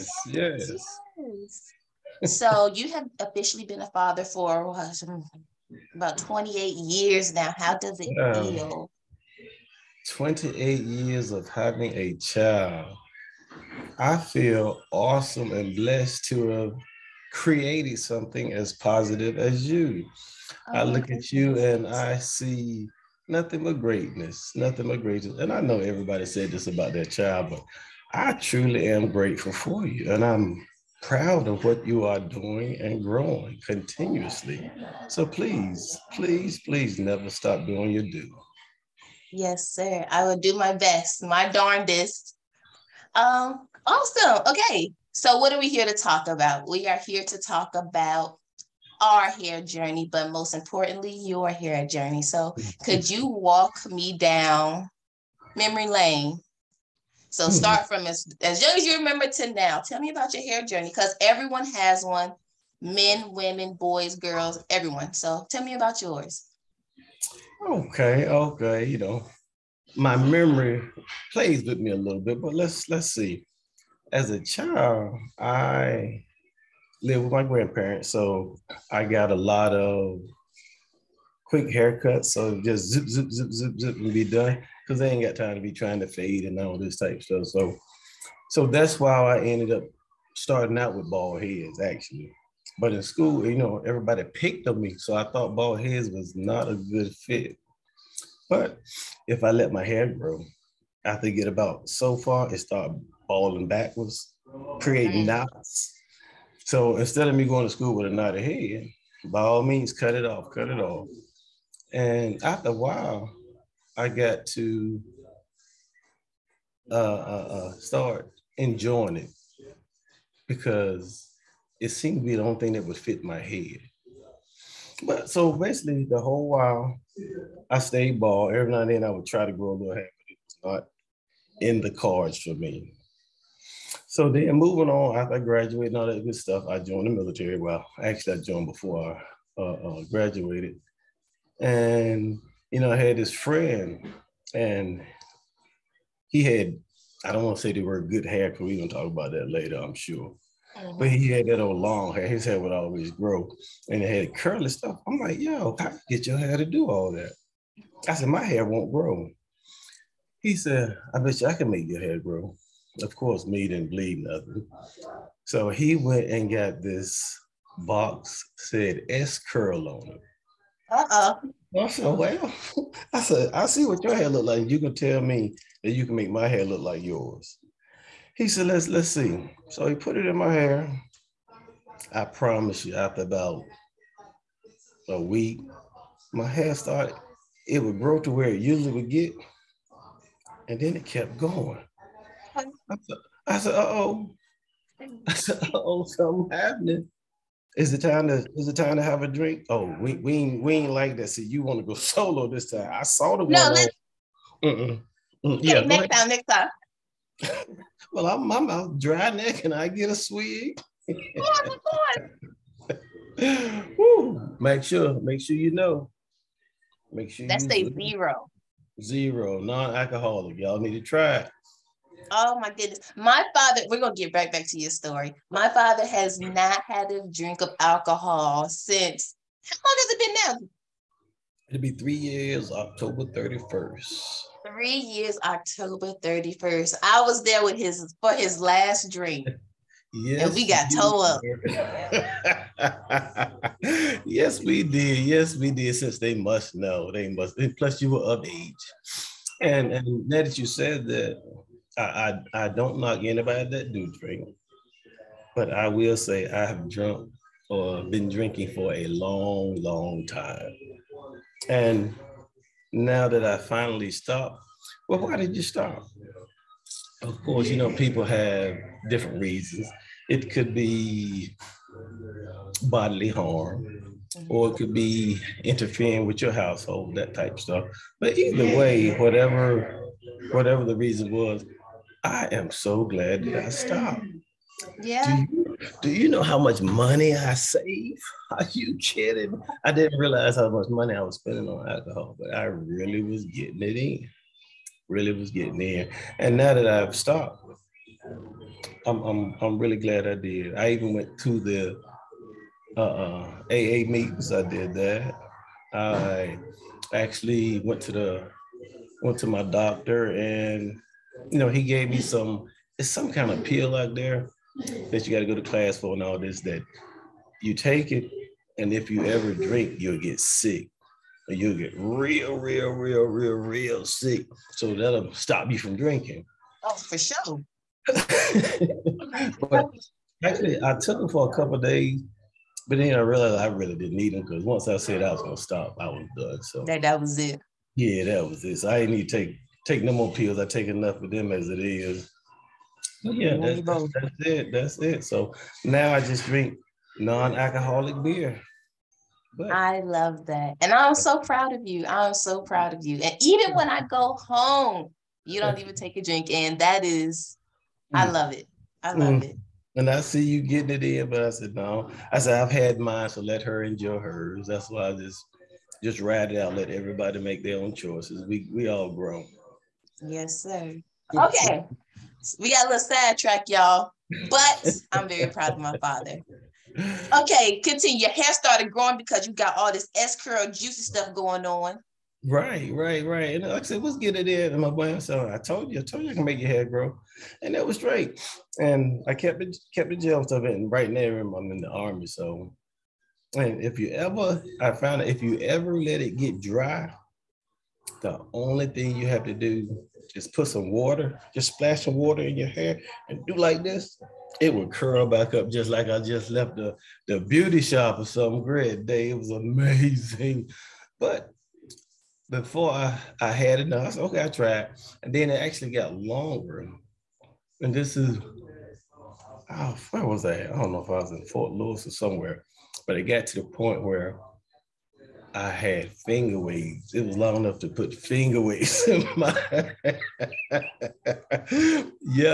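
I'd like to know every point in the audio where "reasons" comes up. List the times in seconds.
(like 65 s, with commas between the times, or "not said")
269 s, 280 s.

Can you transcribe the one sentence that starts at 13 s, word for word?
I feel awesome and blessed to have creating something as positive as you.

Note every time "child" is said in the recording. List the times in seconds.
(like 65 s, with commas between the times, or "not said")
12 s, 27 s, 74 s.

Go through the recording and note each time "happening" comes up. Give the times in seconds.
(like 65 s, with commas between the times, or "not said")
196 s.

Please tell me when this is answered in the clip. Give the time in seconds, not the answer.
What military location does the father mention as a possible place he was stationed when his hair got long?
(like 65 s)
421 s.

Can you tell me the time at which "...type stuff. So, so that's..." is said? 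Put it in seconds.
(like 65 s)
86 s.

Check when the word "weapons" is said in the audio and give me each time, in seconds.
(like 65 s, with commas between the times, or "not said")
not said.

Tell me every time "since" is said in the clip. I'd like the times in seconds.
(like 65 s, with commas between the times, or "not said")
228 s, 245 s.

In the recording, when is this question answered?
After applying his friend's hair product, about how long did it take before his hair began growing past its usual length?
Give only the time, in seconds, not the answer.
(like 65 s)
183 s.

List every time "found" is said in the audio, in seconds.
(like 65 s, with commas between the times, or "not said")
394 s.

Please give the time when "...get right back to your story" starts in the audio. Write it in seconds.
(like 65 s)
224 s.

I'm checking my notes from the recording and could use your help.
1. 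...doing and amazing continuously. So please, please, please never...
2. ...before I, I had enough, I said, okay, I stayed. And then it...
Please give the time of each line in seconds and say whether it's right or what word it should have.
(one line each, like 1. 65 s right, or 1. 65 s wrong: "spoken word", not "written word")
1. 32 s wrong: "growing", not "amazing"
2. 412 s wrong: "tried", not "stayed".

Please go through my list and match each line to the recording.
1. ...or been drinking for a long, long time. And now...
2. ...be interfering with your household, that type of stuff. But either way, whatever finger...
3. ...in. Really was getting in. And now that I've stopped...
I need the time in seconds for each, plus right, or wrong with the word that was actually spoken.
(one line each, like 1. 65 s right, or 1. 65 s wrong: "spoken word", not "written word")
1. 257 s right
2. 274 s wrong: "whatever", not "finger"
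3. 293 s right.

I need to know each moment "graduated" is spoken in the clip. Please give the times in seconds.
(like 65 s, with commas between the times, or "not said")
135 s, 140 s.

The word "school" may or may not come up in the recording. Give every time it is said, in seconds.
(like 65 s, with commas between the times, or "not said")
93 s, 107 s.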